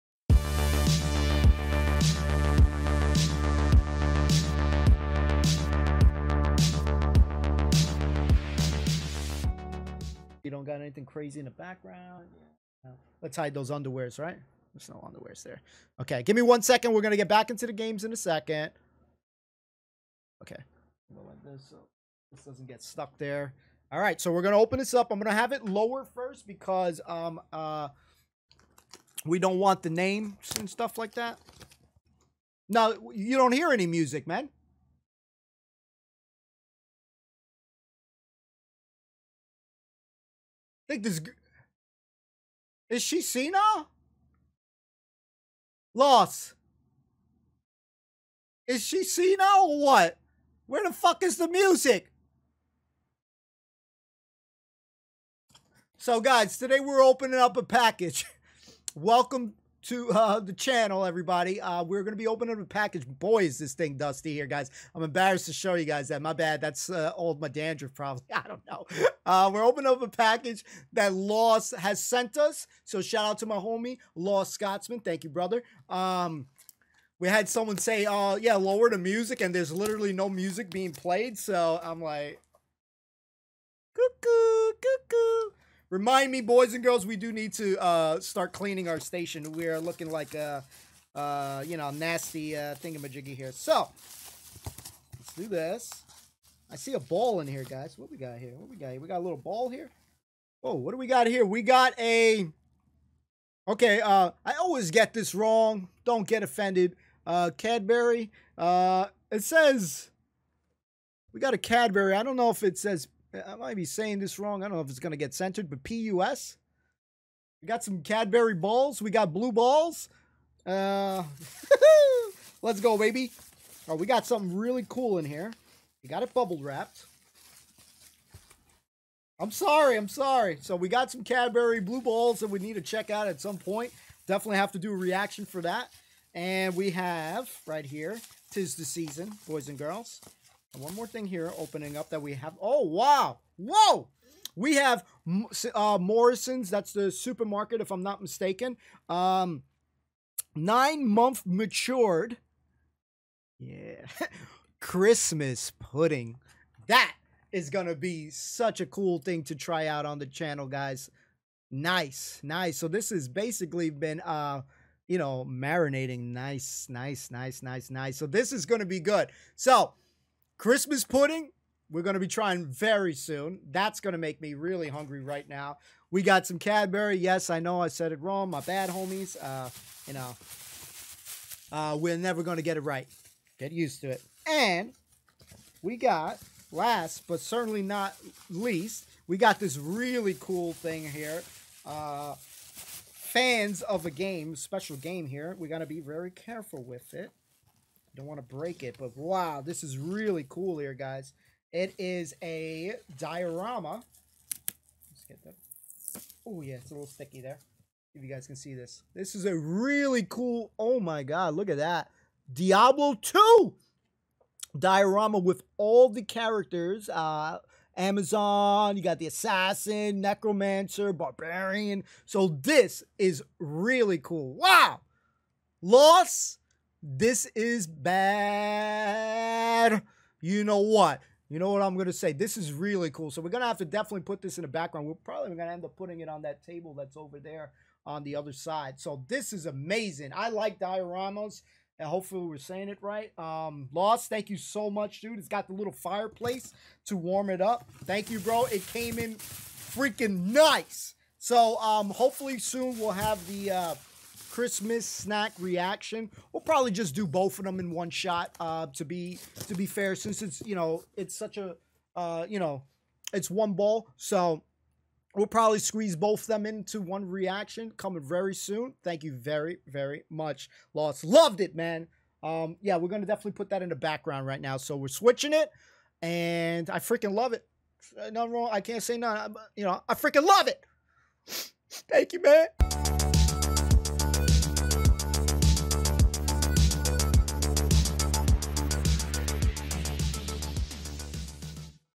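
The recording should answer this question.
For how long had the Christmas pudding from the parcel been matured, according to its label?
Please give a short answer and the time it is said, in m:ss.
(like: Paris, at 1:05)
9 months, at 2:30.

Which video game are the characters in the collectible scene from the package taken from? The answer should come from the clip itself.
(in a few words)
Diablo 2.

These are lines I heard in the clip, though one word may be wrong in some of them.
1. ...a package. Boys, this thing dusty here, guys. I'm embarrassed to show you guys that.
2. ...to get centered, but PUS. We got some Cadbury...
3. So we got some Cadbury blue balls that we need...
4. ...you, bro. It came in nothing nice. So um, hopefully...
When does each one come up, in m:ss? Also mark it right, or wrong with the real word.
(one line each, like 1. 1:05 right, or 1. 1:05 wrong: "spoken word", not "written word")
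1. 1:02 right
2. 1:55 right
3. 2:10 right
4. 4:08 wrong: "freaking", not "nothing".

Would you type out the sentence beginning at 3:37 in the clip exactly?
Uh, Amazon, you got the Assassin, Necromancer, Barbarian.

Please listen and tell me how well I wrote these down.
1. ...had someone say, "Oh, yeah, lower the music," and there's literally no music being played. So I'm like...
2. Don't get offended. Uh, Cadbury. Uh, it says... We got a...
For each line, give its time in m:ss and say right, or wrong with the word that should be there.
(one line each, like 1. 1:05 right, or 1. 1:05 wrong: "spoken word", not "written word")
1. 1:17 right
2. 1:46 right.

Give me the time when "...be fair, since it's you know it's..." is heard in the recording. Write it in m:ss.
4:19.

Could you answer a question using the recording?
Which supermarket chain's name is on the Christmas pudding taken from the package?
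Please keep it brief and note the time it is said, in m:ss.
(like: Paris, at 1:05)
Morrison's, at 2:25.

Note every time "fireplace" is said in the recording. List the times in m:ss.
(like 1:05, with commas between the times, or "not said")
4:05.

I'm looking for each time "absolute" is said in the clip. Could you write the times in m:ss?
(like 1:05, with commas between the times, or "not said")
not said.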